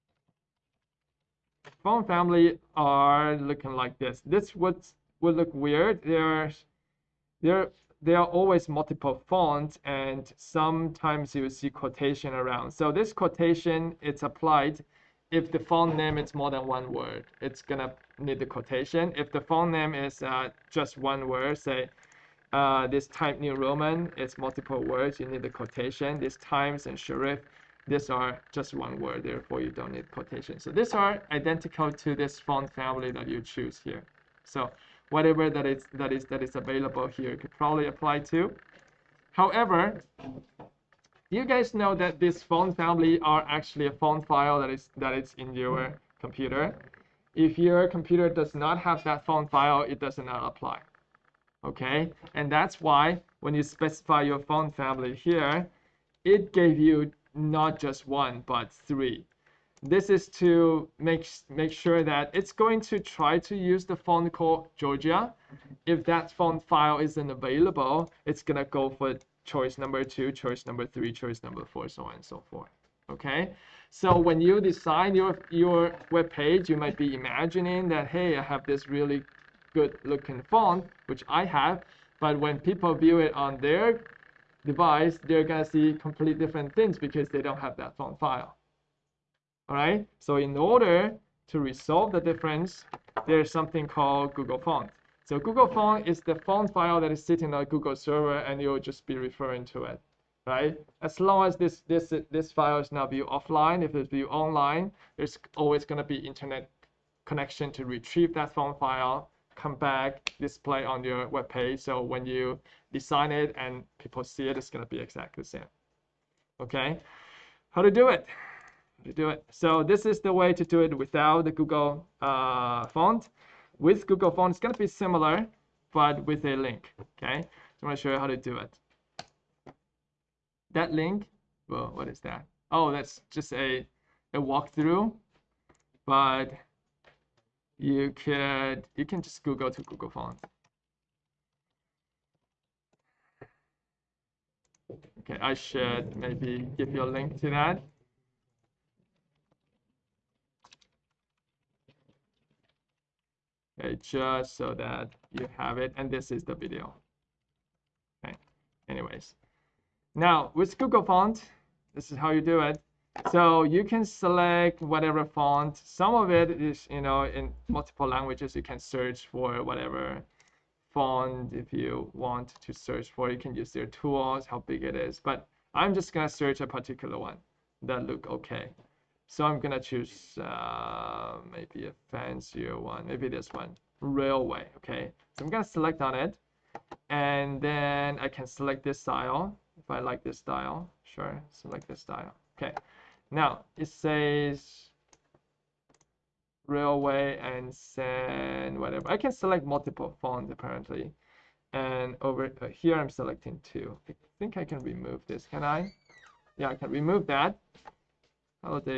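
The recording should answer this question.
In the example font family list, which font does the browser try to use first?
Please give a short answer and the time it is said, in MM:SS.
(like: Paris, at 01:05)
Georgia, at 01:04.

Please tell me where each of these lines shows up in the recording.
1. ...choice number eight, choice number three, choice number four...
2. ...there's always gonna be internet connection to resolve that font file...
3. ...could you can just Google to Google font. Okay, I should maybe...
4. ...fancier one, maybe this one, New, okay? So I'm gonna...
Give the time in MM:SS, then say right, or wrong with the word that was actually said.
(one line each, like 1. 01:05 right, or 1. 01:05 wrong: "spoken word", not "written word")
1. 01:09 wrong: "two", not "eight"
2. 01:45 wrong: "retrieve", not "resolve"
3. 02:18 right
4. 03:02 wrong: "Raleway", not "New".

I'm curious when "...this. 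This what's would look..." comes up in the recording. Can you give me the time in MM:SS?
00:03.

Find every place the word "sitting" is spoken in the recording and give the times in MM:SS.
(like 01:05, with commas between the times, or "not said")
01:37.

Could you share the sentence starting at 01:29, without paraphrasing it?
All right, so in order to resolve the difference, there's something called Google Font.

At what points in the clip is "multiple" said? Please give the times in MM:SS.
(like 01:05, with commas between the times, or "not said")
00:08, 00:24, 02:47, 03:19.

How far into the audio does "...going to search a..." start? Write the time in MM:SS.
02:56.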